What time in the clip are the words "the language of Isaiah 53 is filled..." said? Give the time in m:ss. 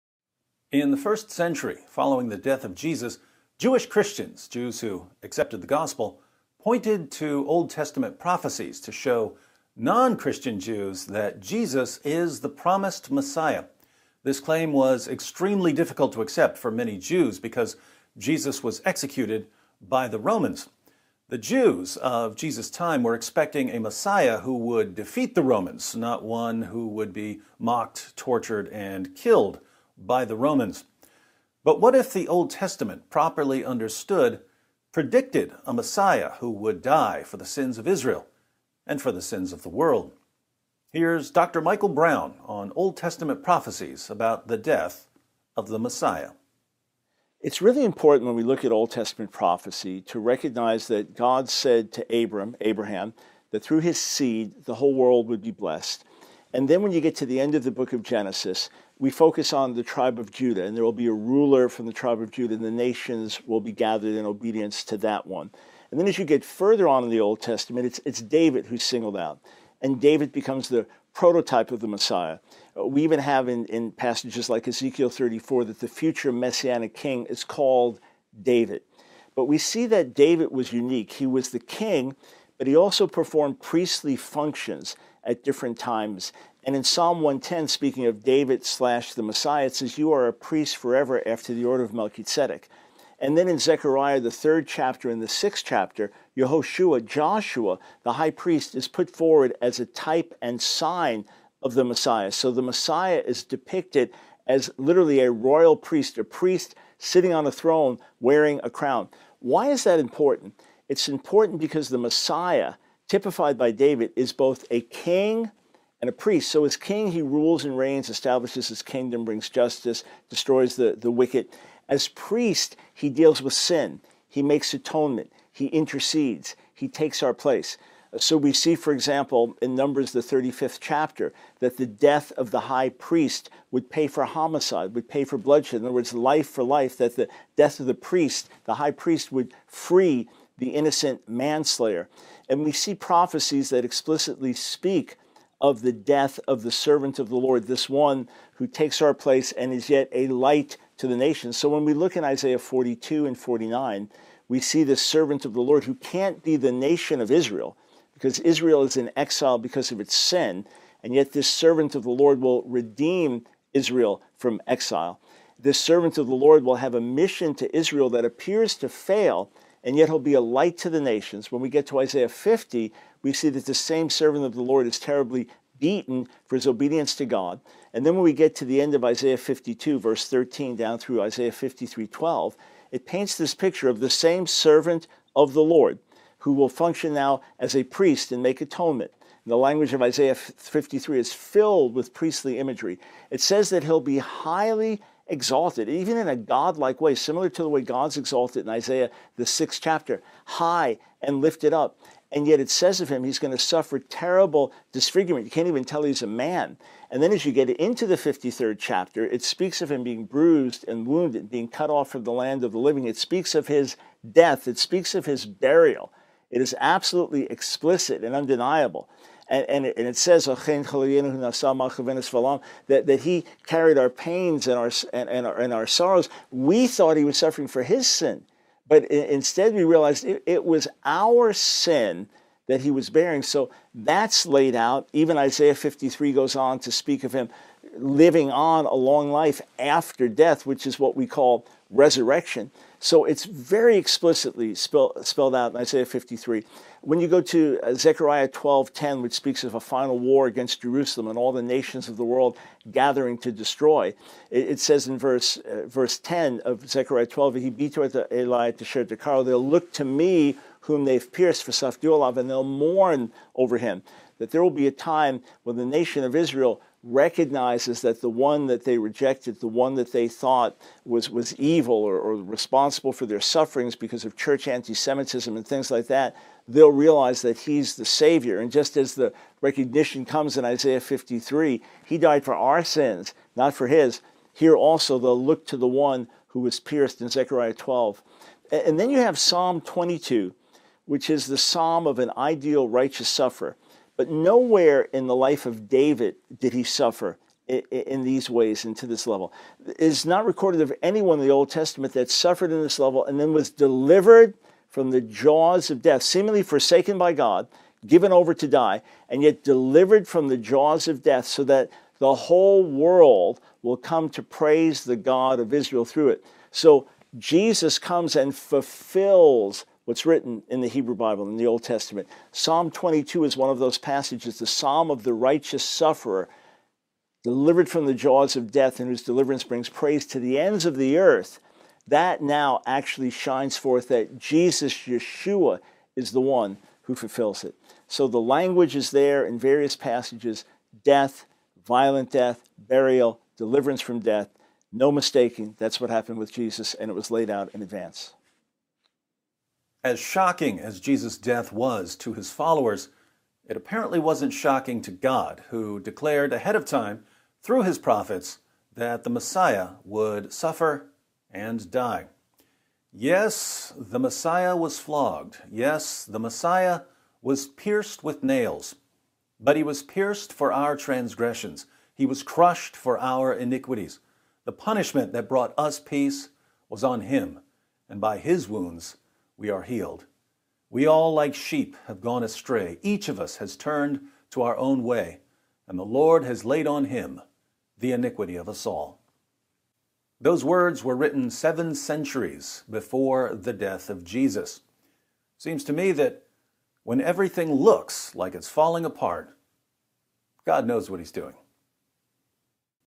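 3:09.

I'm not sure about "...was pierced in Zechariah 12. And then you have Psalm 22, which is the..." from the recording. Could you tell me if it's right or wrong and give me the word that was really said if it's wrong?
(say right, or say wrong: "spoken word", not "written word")
right.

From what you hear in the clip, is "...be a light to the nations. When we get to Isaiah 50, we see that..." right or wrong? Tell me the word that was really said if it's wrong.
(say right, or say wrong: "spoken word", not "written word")
right.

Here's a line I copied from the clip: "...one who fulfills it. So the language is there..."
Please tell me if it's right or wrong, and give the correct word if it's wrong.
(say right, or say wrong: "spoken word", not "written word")
right.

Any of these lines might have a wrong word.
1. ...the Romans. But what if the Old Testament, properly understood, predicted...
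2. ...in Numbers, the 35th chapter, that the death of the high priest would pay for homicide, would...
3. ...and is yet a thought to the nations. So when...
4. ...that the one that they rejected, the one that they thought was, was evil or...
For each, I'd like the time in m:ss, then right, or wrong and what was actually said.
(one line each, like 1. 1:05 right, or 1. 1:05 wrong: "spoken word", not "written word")
1. 0:30 right
2. 2:09 right
3. 2:29 wrong: "light", not "thought"
4. 4:28 right.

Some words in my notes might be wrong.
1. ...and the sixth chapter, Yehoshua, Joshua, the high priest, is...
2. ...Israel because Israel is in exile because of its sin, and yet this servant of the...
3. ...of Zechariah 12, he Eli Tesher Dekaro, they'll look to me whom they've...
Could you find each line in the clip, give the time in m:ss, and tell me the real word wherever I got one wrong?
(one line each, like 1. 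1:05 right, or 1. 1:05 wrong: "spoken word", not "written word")
1. 1:35 right
2. 2:37 right
3. 4:16 right.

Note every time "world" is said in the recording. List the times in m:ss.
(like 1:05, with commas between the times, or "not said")
0:39, 0:54, 4:12, 5:12.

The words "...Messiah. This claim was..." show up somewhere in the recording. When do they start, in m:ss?
0:13.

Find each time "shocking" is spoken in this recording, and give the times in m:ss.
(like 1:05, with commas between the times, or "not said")
5:50, 5:54.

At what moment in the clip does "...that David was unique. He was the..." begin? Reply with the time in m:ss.
1:19.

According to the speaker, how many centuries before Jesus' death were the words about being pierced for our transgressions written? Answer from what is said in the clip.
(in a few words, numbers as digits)
7.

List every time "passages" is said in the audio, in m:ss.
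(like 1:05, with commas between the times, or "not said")
1:13, 5:23, 5:39.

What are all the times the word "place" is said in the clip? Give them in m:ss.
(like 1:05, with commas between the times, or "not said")
2:07, 2:29.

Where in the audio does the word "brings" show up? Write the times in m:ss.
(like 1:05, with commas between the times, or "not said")
1:59, 5:29.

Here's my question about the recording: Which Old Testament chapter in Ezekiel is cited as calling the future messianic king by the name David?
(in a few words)
Ezekiel 34.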